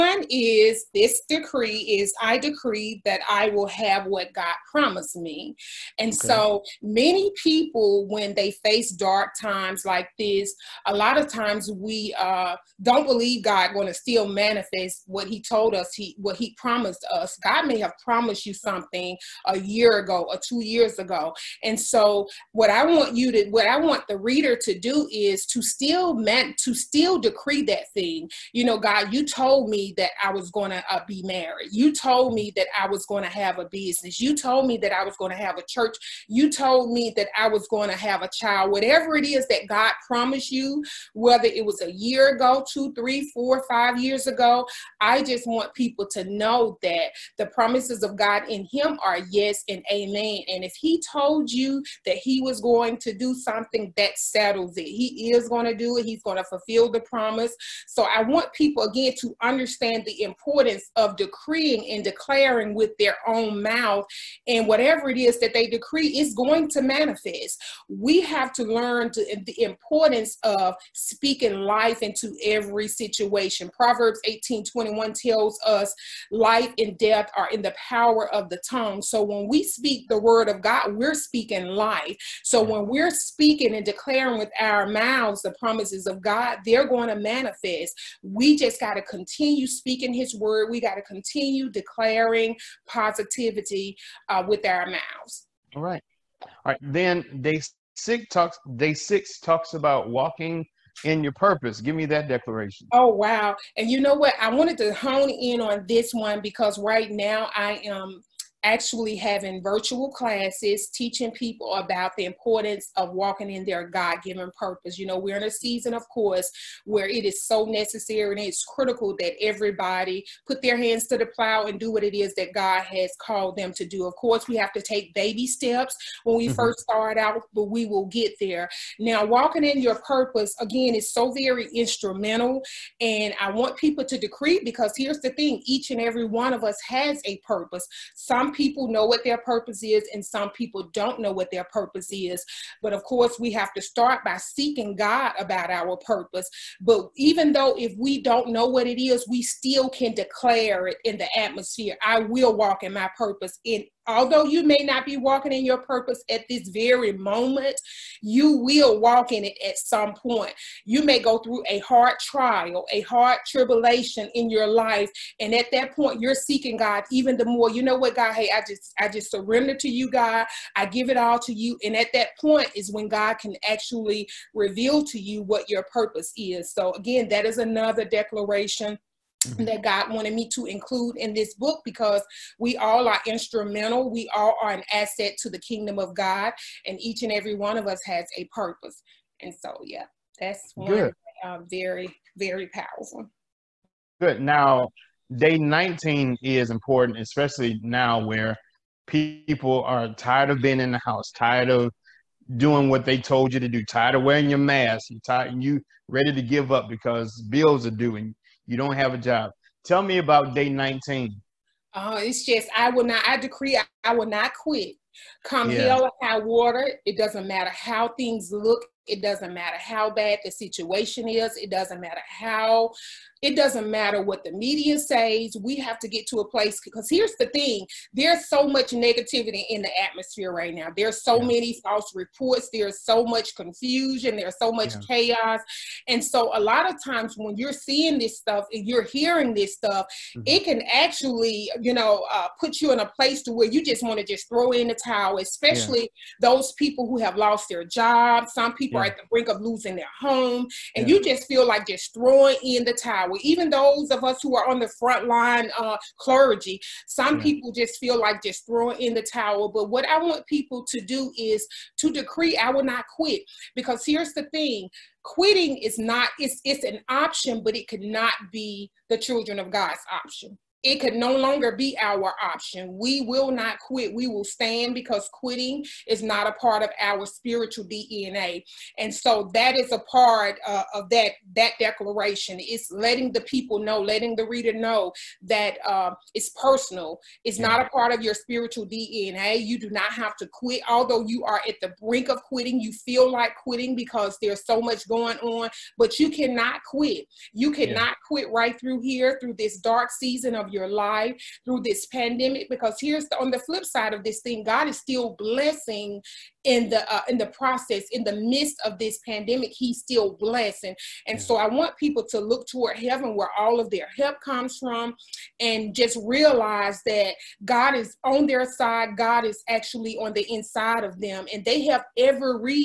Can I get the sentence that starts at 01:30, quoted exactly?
We got to continue declaring positivity uh, with our mouths.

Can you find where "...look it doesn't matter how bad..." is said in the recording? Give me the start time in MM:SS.
03:38.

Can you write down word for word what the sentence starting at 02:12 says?
And I want people to decree because here's the thing each and every one of us has a purpose.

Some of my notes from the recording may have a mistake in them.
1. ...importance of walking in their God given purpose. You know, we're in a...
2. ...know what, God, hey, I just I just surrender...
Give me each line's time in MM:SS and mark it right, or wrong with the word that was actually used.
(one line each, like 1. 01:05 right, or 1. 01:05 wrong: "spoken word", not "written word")
1. 01:52 right
2. 02:47 right.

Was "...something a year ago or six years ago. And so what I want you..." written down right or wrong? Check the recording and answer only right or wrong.
wrong.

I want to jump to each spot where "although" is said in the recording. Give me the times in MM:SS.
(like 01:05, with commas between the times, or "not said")
02:34, 04:50.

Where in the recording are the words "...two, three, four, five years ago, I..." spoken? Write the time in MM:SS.
00:42.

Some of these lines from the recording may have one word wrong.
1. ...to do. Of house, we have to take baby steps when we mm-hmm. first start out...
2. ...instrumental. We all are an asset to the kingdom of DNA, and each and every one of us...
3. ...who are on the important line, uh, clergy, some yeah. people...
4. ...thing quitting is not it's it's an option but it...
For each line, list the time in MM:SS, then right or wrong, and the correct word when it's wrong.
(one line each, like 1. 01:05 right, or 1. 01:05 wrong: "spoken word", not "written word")
1. 02:03 wrong: "course", not "house"
2. 03:03 wrong: "God", not "DNA"
3. 04:14 wrong: "front", not "important"
4. 04:24 right.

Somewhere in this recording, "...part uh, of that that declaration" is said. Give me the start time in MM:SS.
04:39.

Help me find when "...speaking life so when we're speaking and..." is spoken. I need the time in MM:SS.
01:21.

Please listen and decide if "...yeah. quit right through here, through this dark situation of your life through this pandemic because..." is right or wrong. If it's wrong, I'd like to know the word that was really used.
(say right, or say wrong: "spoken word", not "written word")
wrong: "season", not "situation".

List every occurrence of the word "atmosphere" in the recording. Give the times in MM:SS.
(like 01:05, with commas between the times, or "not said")
02:31, 03:50.